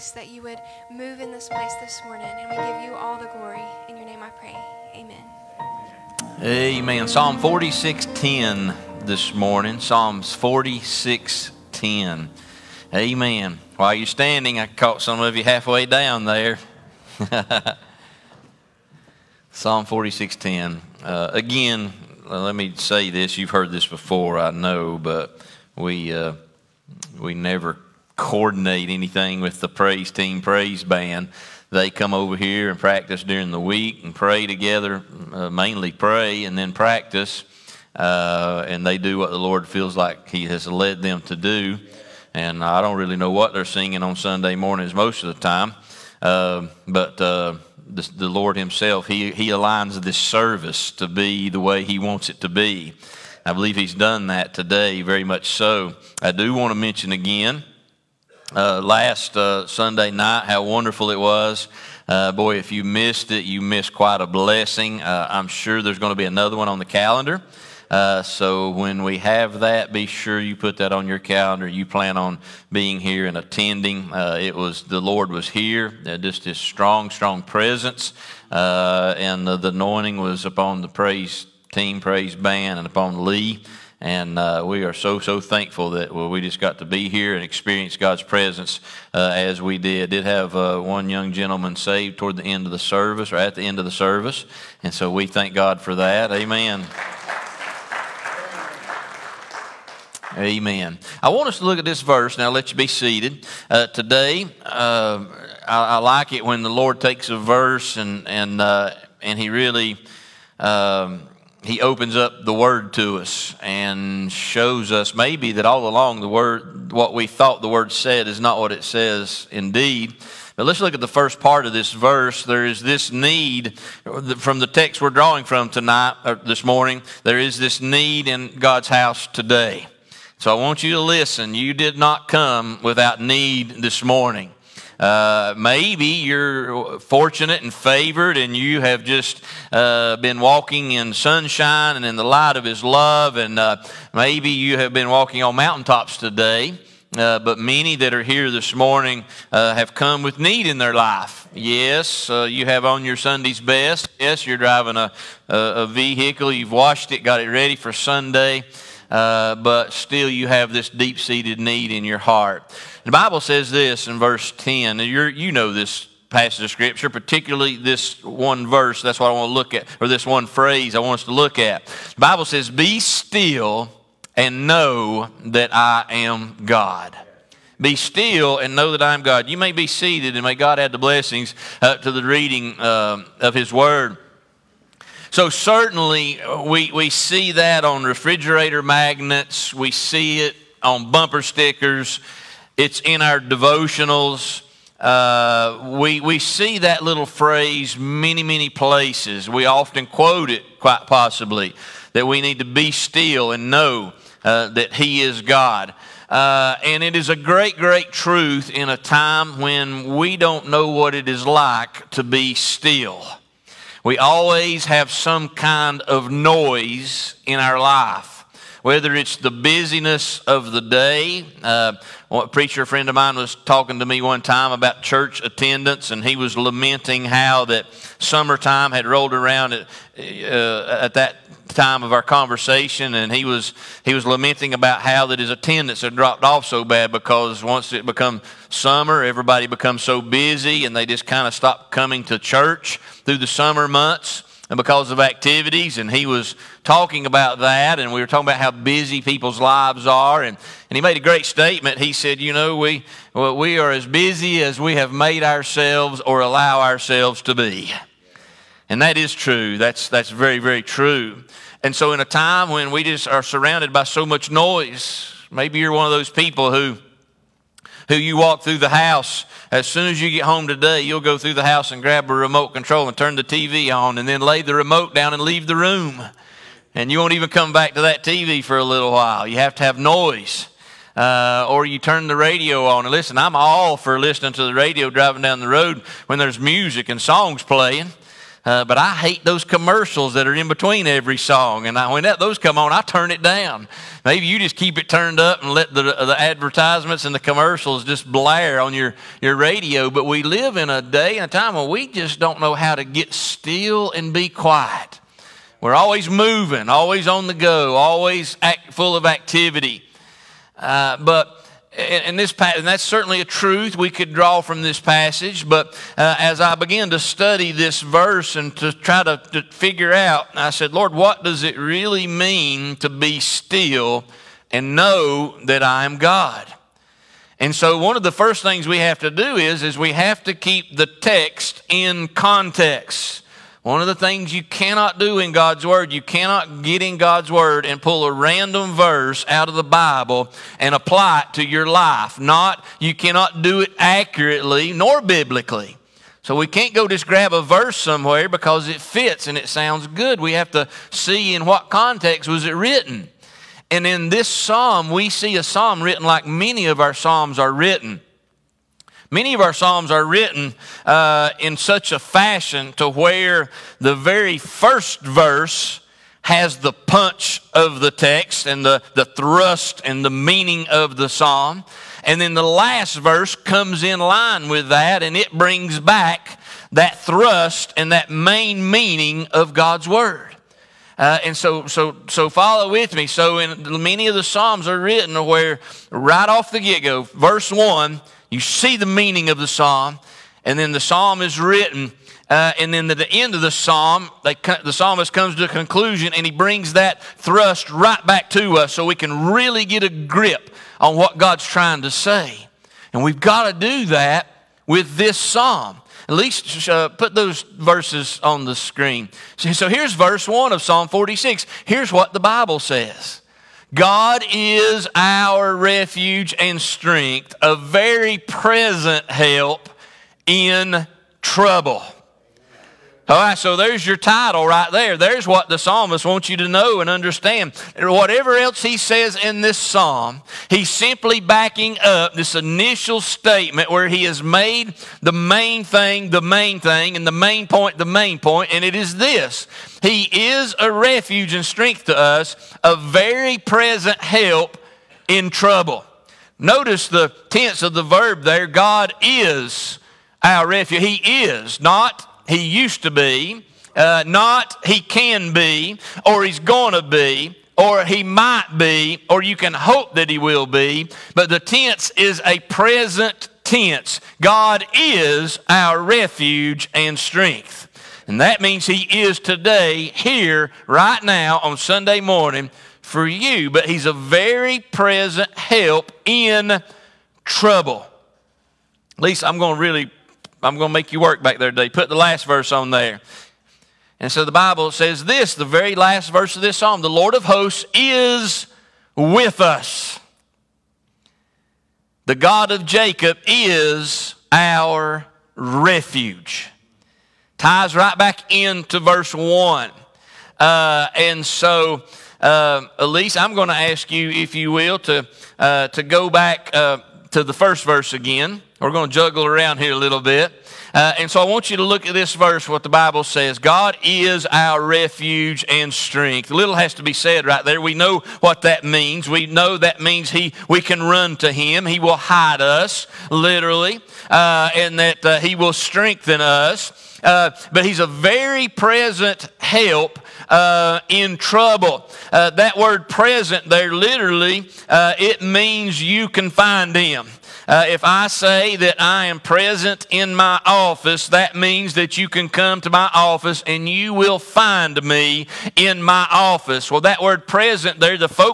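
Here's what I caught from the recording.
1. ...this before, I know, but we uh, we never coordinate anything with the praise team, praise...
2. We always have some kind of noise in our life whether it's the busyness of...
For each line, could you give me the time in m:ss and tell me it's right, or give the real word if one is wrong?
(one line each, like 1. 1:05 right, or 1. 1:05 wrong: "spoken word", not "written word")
1. 0:23 right
2. 3:34 right.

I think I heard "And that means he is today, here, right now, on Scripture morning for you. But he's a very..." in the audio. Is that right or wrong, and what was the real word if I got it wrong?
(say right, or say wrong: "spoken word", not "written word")
wrong: "Sunday", not "Scripture".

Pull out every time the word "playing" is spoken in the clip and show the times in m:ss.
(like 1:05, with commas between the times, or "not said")
4:47.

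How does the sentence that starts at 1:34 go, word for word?
And so we thank God for that.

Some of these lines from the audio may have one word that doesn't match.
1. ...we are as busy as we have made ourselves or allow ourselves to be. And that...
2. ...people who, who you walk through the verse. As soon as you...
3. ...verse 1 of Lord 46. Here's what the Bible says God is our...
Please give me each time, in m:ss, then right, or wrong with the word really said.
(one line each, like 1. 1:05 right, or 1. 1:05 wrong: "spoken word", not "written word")
1. 4:13 right
2. 4:26 wrong: "house", not "verse"
3. 6:50 wrong: "Psalm", not "Lord".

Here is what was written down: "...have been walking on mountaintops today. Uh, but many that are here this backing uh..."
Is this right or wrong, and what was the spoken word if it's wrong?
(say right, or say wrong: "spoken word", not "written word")
wrong: "morning", not "backing".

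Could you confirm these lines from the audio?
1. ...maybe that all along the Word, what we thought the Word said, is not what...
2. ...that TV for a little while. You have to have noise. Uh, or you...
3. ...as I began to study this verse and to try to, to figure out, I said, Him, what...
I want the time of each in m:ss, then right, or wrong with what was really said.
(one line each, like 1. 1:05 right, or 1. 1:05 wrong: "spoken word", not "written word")
1. 1:55 right
2. 4:38 right
3. 5:16 wrong: "Lord", not "Him".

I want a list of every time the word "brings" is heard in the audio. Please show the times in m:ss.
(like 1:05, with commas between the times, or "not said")
6:15, 6:36.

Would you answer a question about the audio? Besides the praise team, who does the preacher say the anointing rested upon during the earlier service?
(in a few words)
Lee.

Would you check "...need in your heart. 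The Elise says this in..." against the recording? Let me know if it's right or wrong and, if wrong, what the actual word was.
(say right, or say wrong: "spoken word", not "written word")
wrong: "Bible", not "Elise".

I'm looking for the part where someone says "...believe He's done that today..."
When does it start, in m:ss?
0:53.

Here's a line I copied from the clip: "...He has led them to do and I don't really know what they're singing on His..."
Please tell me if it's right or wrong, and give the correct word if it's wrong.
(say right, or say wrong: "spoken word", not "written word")
wrong: "Sunday", not "His".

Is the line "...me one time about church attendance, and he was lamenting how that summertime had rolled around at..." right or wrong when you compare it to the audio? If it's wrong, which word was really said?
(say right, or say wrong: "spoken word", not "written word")
right.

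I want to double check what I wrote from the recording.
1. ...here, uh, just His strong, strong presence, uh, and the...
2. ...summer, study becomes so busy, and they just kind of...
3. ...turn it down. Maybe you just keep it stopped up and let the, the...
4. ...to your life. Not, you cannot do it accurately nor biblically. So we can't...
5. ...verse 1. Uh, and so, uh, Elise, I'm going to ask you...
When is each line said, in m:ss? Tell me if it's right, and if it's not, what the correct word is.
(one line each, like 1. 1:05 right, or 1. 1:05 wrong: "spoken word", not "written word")
1. 1:15 right
2. 3:58 wrong: "everybody", not "study"
3. 4:52 wrong: "turned", not "stopped"
4. 5:41 right
5. 8:18 right.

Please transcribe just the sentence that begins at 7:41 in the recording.
But the tense is a present tense.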